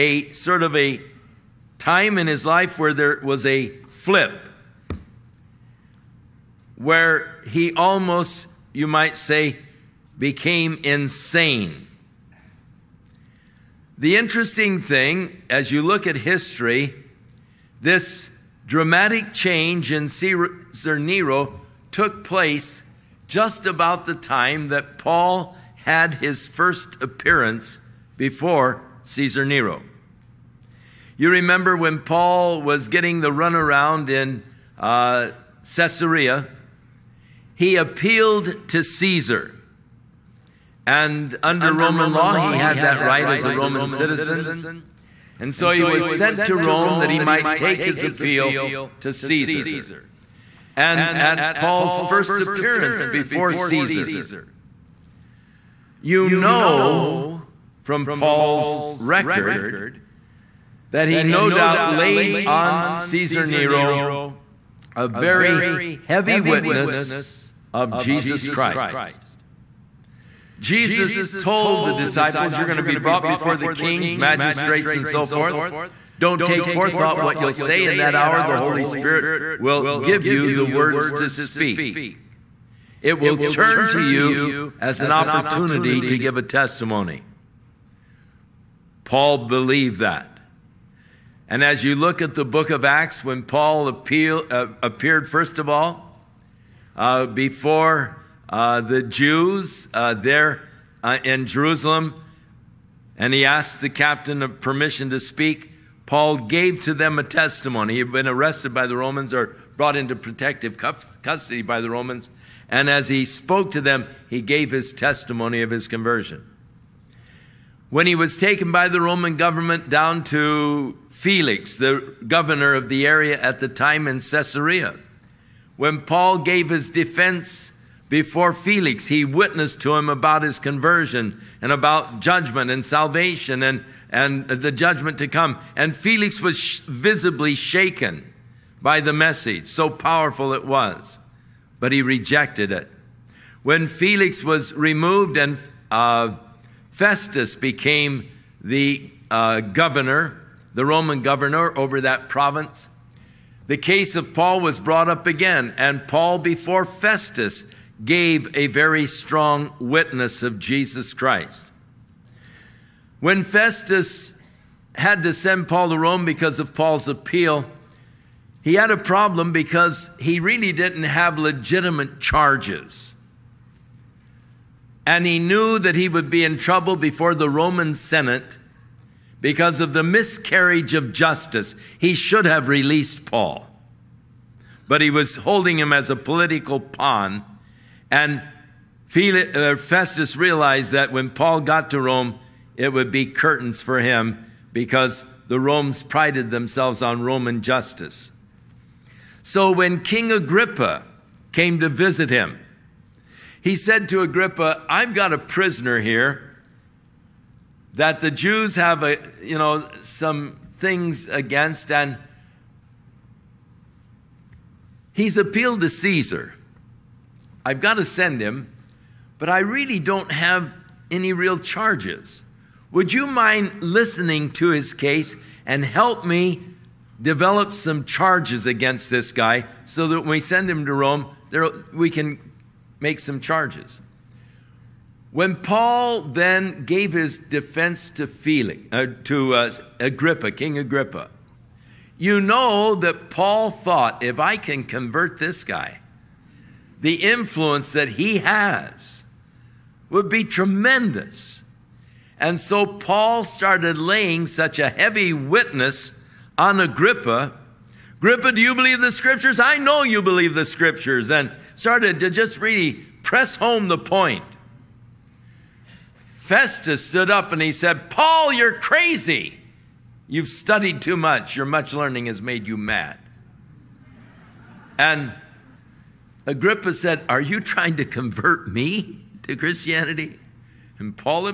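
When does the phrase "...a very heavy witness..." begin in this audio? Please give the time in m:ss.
1:04.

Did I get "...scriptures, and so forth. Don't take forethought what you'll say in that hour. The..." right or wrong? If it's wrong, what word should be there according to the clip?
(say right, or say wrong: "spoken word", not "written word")
wrong: "magistrates", not "scriptures".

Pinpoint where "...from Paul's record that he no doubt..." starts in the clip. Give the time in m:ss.
0:57.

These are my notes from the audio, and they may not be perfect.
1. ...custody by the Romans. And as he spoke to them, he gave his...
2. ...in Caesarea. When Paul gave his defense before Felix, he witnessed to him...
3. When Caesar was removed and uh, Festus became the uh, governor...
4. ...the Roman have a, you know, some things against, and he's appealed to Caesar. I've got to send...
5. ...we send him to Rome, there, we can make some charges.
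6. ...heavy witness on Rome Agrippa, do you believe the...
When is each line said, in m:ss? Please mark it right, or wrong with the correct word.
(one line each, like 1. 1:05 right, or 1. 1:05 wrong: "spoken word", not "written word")
1. 1:50 right
2. 2:04 right
3. 2:23 wrong: "Felix", not "Caesar"
4. 3:28 wrong: "Jews", not "Roman"
5. 3:50 right
6. 4:14 wrong: "Agrippa", not "Rome".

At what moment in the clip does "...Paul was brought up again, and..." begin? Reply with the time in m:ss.
2:34.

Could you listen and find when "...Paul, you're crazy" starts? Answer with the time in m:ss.
4:28.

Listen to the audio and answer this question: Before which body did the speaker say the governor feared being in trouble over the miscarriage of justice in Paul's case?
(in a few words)
the Roman Senate.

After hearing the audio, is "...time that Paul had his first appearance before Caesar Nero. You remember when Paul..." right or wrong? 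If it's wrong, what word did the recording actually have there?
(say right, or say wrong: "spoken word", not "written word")
right.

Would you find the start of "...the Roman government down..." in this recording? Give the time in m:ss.
1:58.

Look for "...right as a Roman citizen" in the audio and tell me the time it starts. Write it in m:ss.
0:43.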